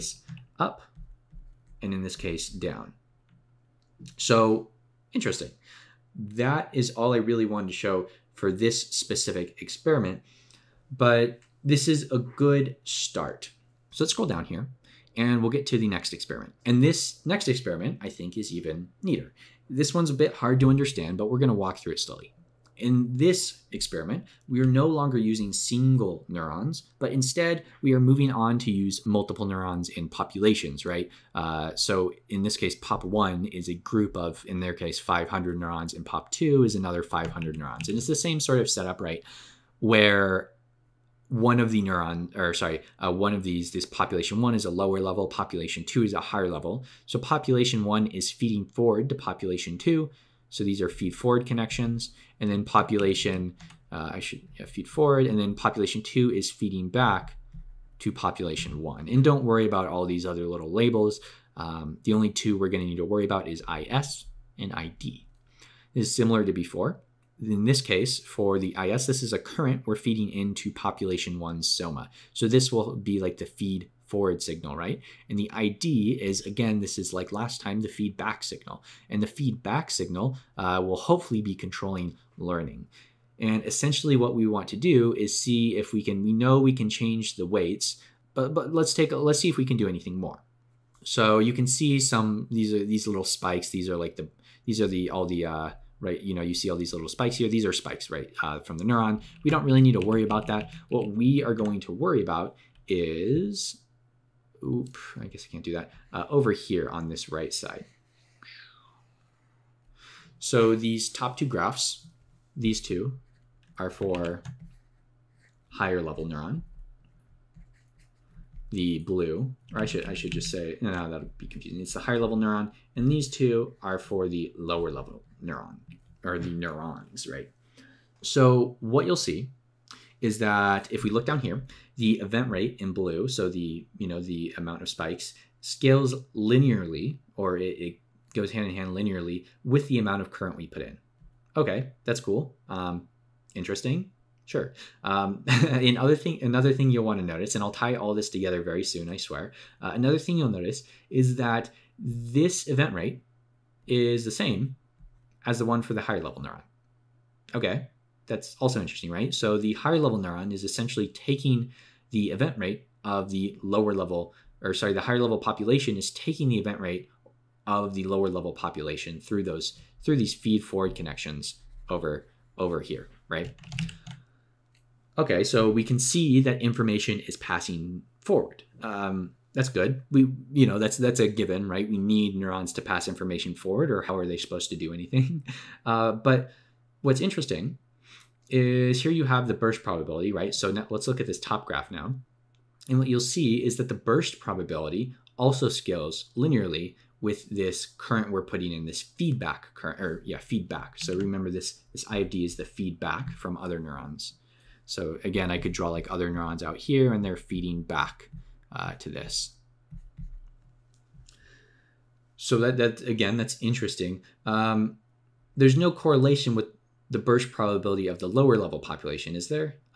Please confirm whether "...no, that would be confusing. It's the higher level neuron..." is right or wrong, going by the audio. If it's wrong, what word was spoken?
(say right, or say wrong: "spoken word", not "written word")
right.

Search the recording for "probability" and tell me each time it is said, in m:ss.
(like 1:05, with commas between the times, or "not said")
3:09, 3:14, 3:37.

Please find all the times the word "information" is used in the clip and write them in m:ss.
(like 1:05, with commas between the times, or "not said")
2:56, 3:03.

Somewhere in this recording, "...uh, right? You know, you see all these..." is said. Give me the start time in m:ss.
1:35.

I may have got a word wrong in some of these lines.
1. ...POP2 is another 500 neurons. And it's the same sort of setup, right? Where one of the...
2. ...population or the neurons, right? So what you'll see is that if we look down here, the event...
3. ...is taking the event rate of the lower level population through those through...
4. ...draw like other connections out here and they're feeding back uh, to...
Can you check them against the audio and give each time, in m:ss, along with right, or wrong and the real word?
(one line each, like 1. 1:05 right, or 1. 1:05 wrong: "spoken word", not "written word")
1. 0:36 right
2. 2:05 wrong: "neuron", not "population"
3. 2:45 right
4. 3:25 wrong: "neurons", not "connections".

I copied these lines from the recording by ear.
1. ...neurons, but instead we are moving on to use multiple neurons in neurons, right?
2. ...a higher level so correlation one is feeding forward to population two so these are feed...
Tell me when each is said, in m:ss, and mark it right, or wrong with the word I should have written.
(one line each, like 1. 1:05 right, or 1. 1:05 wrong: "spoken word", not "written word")
1. 0:26 wrong: "populations", not "neurons"
2. 0:46 wrong: "population", not "correlation".